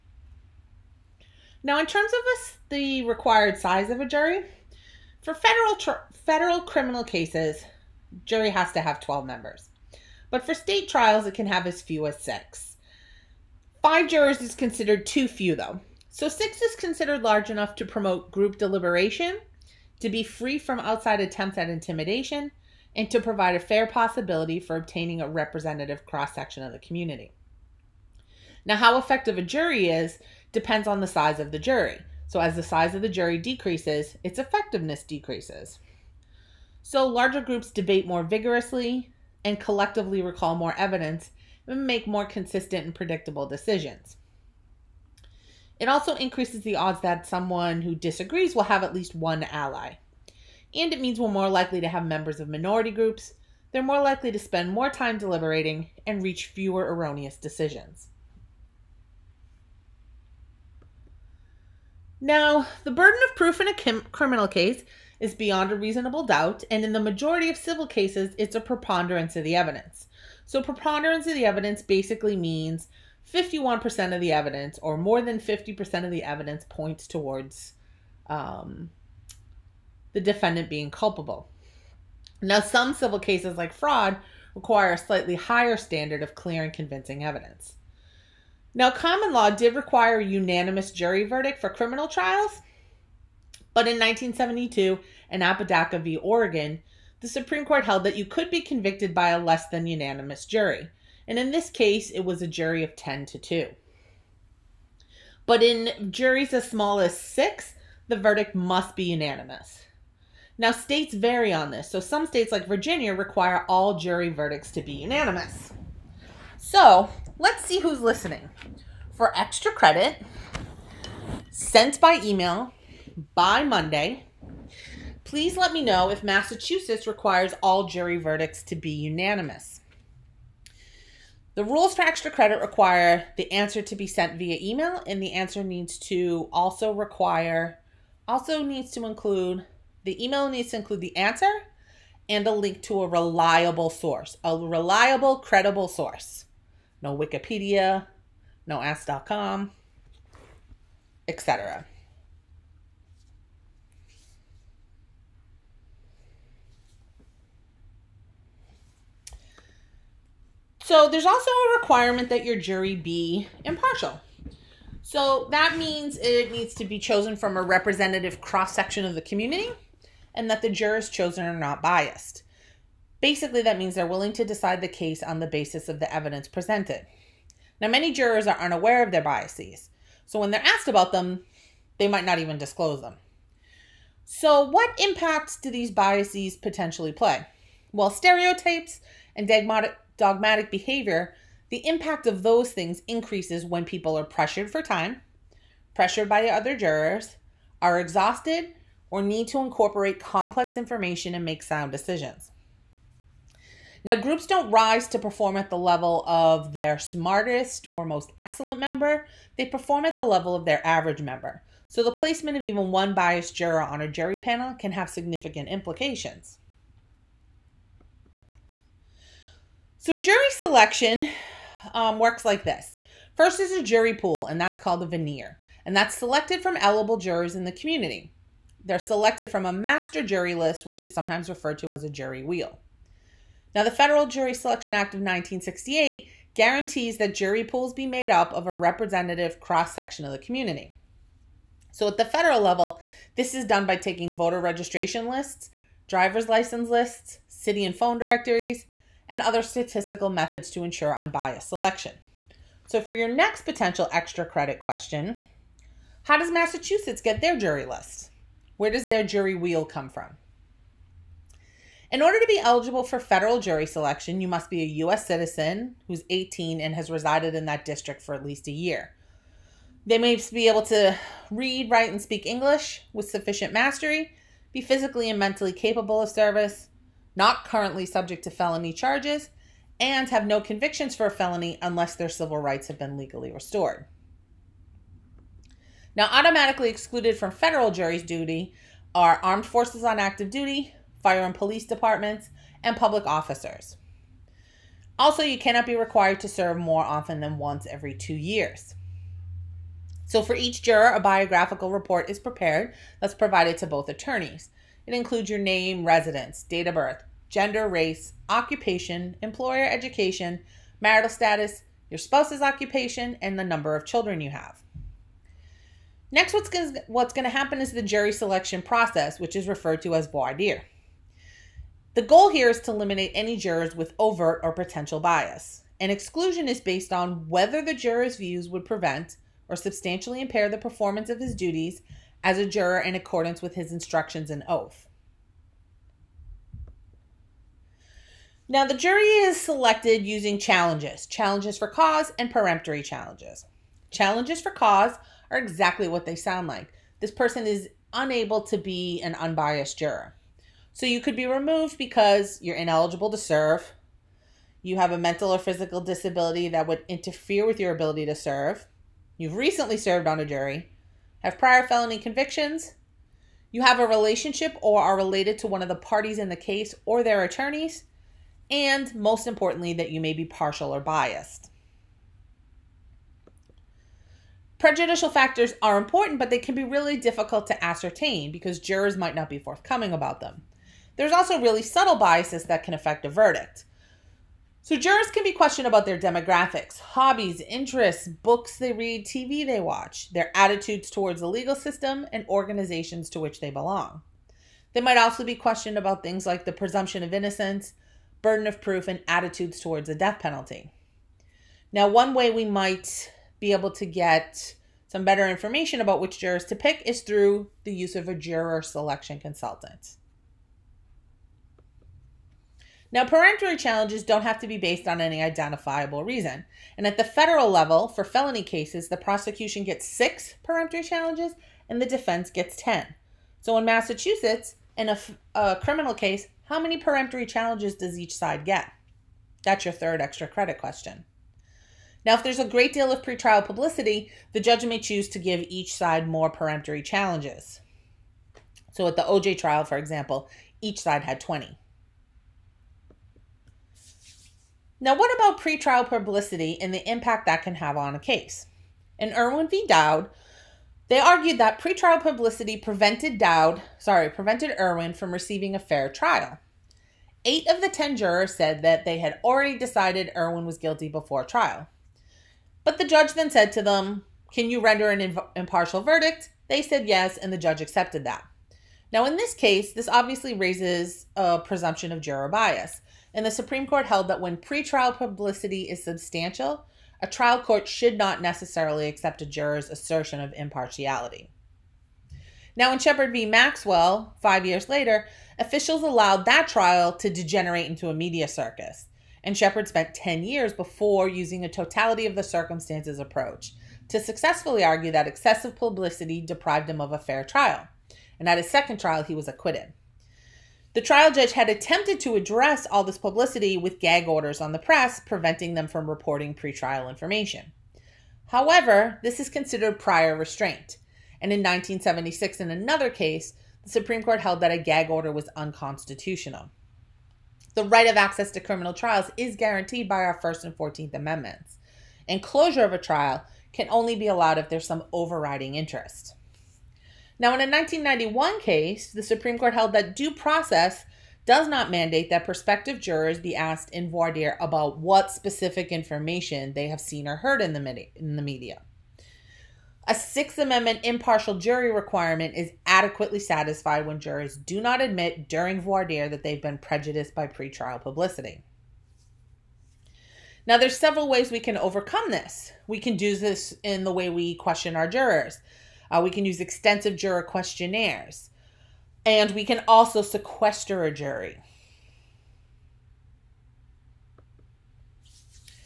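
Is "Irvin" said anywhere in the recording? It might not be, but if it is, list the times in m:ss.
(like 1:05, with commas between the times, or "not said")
7:29, 7:34, 7:40.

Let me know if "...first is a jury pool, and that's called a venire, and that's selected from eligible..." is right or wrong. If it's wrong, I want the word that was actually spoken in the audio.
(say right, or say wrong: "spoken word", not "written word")
right.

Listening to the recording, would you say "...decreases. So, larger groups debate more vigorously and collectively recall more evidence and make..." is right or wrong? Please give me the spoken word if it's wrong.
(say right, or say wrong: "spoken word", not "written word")
right.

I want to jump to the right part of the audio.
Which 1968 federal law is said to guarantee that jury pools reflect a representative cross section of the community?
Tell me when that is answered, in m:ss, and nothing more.
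3:53.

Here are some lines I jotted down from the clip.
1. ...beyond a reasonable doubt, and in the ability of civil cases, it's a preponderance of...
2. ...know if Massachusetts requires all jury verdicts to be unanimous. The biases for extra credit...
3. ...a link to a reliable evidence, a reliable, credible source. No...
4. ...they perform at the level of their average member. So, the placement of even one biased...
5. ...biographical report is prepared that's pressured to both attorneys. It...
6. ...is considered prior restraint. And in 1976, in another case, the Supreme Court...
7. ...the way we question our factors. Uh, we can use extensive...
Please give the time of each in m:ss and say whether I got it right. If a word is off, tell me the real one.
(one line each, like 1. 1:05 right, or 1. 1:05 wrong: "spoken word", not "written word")
1. 1:05 wrong: "majority", not "ability"
2. 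2:05 wrong: "rules", not "biases"
3. 2:22 wrong: "source", not "evidence"
4. 3:29 right
5. 5:01 wrong: "provided", not "pressured"
6. 8:29 right
7. 9:14 wrong: "jurors", not "factors".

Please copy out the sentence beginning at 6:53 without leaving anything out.
Now, peremptory challenges don't have to be based on any identifiable reason.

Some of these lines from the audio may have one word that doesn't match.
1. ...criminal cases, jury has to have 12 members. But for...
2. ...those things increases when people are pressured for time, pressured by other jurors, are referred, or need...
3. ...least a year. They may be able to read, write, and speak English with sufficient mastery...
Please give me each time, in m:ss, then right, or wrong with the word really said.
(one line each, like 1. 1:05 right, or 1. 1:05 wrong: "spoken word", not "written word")
1. 0:06 right
2. 3:12 wrong: "exhausted", not "referred"
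3. 4:28 right.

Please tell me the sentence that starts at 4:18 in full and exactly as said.
Where does their jury wheel come from?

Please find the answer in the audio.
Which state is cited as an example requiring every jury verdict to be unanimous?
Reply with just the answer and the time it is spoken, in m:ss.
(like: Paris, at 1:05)
Virginia, at 1:52.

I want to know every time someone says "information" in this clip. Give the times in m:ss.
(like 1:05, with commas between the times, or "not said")
3:20, 6:45, 8:27, 8:55.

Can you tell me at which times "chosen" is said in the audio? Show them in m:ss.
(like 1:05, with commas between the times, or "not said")
2:46, 2:51.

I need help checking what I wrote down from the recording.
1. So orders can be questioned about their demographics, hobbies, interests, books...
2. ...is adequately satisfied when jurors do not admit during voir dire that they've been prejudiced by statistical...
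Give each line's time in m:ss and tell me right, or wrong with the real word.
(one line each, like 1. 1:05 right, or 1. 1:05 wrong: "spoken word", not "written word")
1. 6:24 wrong: "jurors", not "orders"
2. 9:02 wrong: "pretrial", not "statistical".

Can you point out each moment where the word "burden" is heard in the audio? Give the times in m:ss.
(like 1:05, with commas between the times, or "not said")
1:02, 6:38.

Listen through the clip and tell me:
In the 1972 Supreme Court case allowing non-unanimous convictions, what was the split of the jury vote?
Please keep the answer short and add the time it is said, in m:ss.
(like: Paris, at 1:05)
10 to 2, at 1:42.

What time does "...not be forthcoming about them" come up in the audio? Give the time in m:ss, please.
6:19.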